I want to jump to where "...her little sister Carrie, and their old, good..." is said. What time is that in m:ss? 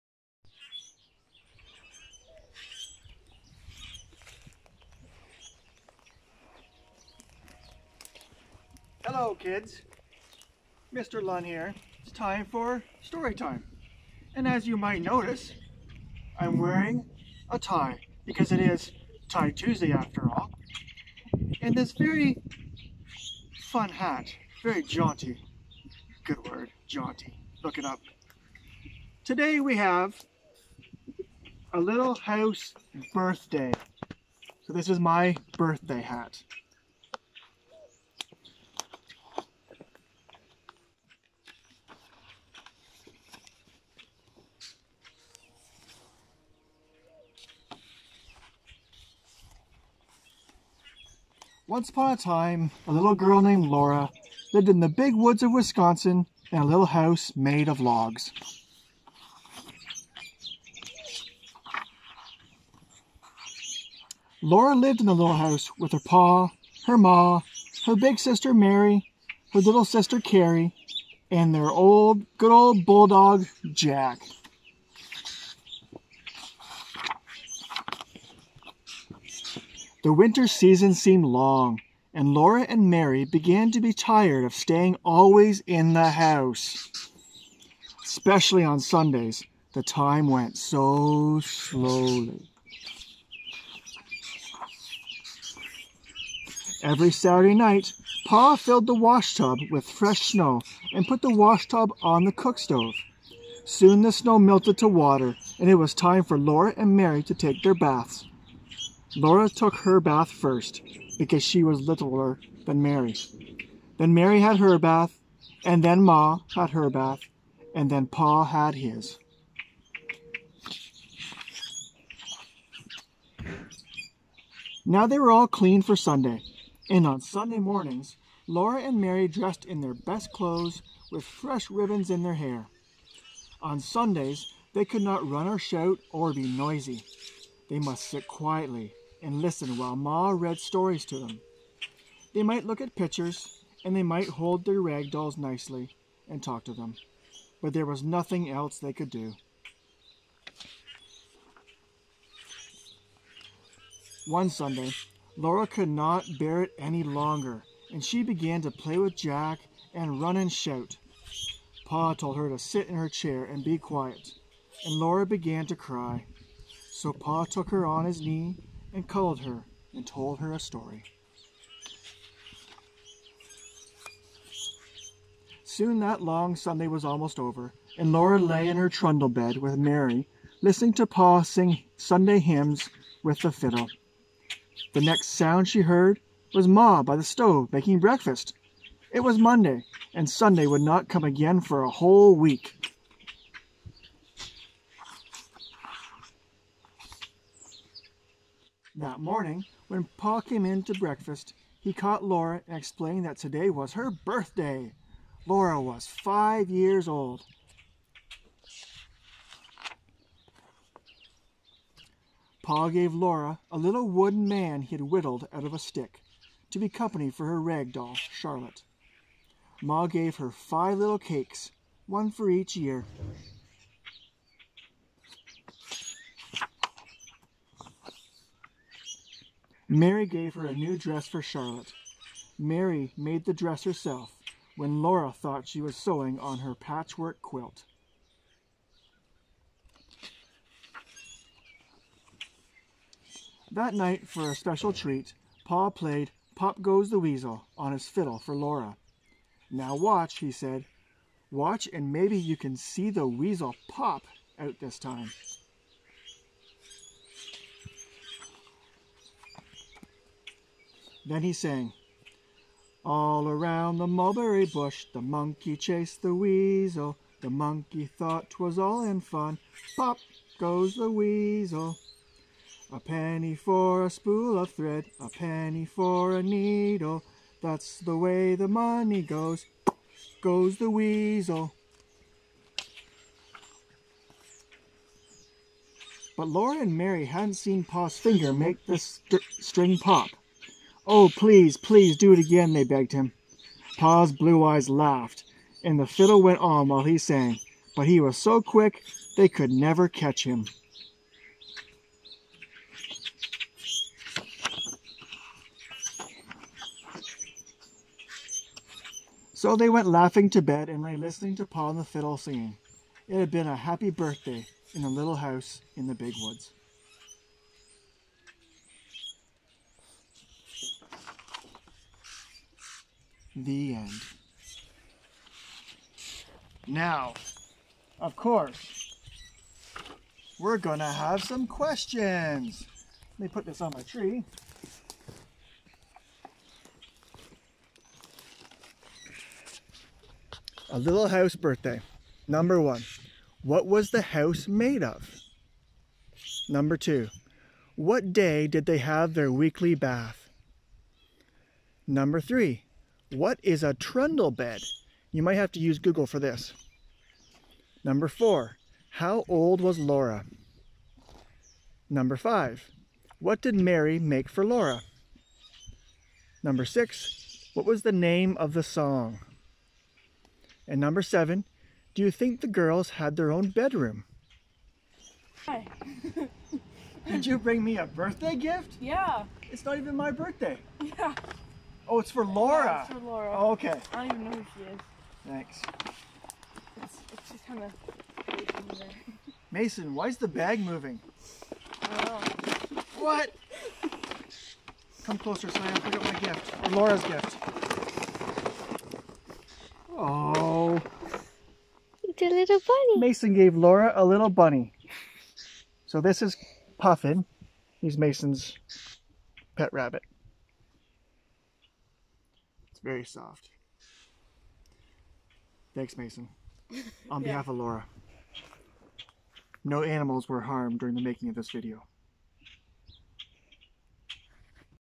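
1:09.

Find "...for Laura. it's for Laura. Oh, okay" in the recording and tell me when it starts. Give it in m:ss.
6:22.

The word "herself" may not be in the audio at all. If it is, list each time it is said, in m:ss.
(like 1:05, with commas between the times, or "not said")
3:53.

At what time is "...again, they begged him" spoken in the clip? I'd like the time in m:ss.
4:52.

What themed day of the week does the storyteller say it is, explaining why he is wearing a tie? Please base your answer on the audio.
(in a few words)
Tie Tuesday.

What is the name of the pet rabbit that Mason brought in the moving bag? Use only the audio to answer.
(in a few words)
Puffin.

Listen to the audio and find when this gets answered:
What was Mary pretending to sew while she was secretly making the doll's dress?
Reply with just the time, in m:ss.
3:56.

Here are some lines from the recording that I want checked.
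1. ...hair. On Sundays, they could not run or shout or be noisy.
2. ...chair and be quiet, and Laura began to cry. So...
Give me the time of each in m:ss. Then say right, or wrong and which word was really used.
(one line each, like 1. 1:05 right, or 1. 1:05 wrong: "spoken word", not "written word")
1. 2:12 right
2. 2:43 right.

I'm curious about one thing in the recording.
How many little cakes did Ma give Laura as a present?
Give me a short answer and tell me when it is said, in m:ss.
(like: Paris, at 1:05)
5, at 3:40.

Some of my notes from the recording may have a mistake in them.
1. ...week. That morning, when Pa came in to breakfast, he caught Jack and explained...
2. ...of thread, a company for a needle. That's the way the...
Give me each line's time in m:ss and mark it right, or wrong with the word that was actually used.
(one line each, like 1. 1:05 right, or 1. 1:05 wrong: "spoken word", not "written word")
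1. 3:12 wrong: "Laura", not "Jack"
2. 4:34 wrong: "penny", not "company".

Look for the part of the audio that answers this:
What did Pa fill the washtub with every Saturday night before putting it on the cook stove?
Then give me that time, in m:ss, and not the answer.
1:39.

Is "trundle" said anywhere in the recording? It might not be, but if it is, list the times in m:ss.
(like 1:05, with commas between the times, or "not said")
2:58, 5:53.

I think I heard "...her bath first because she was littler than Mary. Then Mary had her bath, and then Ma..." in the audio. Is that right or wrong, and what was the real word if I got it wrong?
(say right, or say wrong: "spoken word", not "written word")
right.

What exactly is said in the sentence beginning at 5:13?
It had been a happy birthday in the little house in the big woods.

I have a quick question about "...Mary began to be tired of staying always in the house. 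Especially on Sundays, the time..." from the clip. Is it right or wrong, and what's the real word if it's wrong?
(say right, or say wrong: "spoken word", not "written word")
right.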